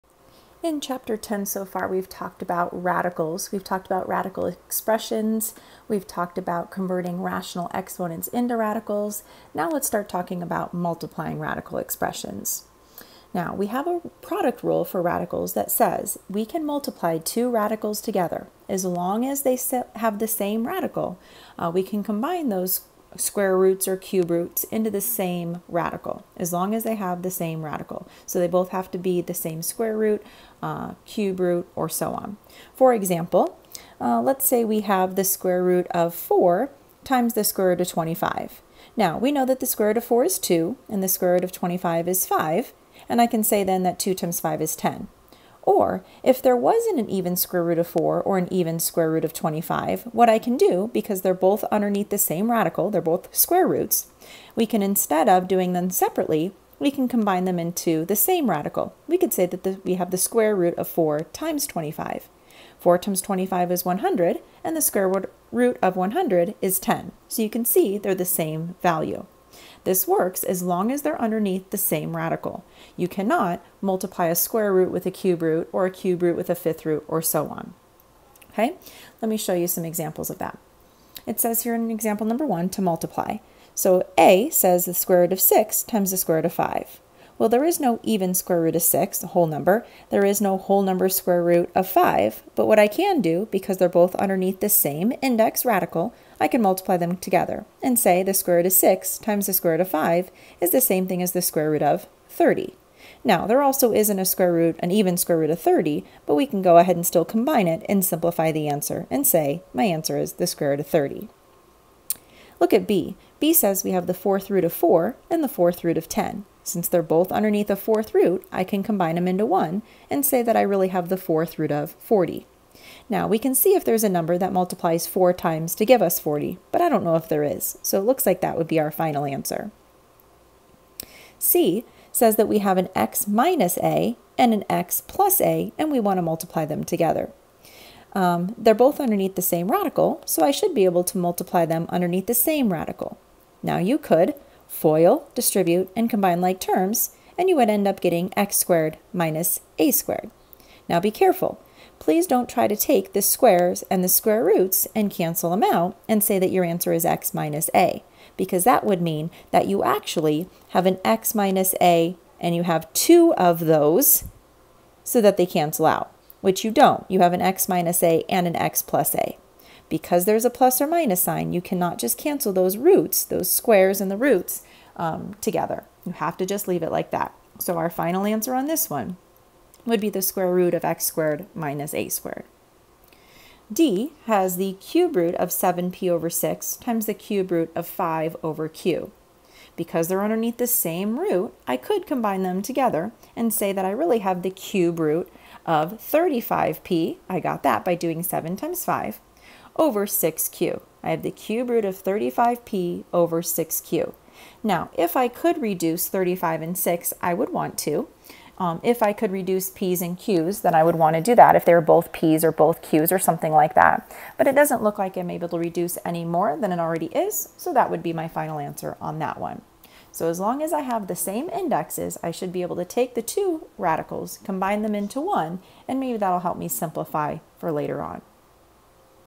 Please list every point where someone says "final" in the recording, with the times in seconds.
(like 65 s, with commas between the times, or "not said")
128 s, 177 s, 218 s.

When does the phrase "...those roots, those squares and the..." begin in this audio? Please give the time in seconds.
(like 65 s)
172 s.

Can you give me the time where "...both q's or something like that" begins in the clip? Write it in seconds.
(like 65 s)
212 s.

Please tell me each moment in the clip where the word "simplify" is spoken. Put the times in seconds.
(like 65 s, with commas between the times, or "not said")
108 s, 226 s.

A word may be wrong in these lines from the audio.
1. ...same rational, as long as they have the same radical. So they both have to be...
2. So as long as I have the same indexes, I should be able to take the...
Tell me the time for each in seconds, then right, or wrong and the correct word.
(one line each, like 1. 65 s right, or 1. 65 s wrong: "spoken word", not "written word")
1. 25 s wrong: "radical", not "rational"
2. 220 s right.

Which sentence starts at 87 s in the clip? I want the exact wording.
Well, there is no even square root of 6, a whole number.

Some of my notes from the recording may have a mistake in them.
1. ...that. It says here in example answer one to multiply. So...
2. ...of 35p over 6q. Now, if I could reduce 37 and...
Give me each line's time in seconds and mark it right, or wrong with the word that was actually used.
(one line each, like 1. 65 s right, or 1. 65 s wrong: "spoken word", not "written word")
1. 80 s wrong: "number", not "answer"
2. 201 s wrong: "35", not "37".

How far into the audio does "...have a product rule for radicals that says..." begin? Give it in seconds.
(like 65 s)
13 s.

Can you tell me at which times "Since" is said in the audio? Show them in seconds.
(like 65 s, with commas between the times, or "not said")
116 s.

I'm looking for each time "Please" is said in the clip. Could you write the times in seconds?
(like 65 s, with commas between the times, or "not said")
151 s.